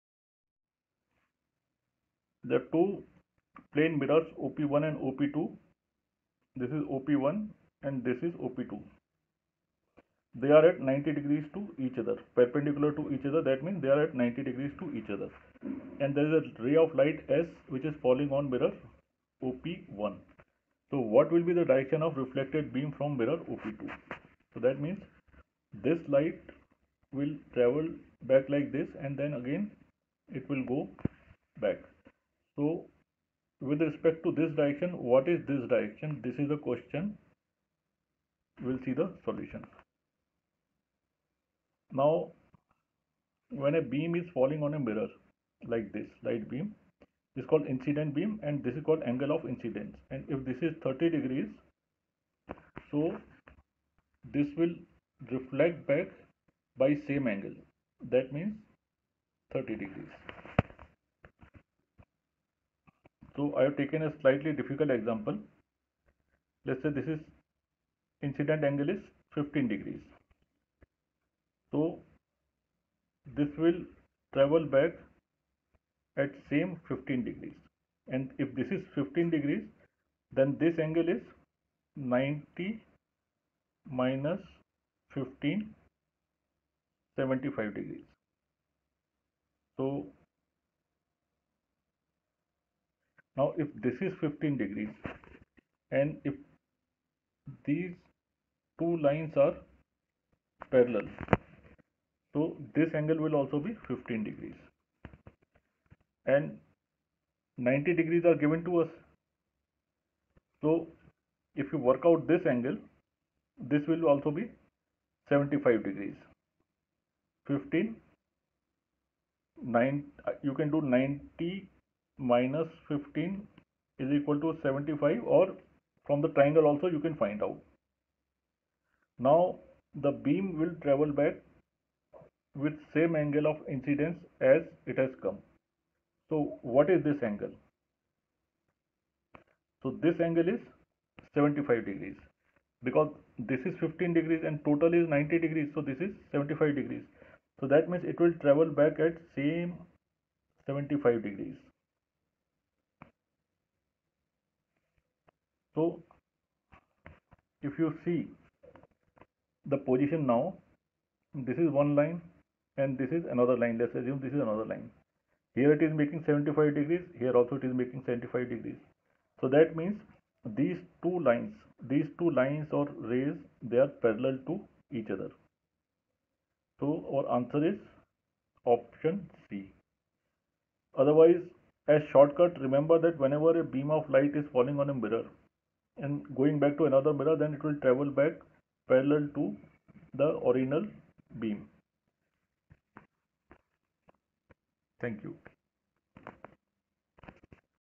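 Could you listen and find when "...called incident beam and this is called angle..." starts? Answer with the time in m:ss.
0:47.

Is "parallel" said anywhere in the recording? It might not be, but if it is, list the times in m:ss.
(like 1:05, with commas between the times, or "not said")
1:40, 2:54, 3:08.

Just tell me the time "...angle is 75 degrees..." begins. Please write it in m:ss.
2:20.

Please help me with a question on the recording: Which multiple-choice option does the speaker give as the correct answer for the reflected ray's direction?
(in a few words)
Option C.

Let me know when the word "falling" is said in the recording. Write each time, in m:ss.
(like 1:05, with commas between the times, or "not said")
0:18, 0:44, 3:04.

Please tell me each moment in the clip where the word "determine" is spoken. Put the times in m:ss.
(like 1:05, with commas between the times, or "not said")
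not said.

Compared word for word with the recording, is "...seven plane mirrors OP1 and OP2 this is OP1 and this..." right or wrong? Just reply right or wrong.
wrong.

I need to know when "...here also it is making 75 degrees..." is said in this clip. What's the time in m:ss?
2:47.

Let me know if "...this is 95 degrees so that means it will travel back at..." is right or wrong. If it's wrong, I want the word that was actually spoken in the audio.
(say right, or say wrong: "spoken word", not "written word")
wrong: "75", not "95".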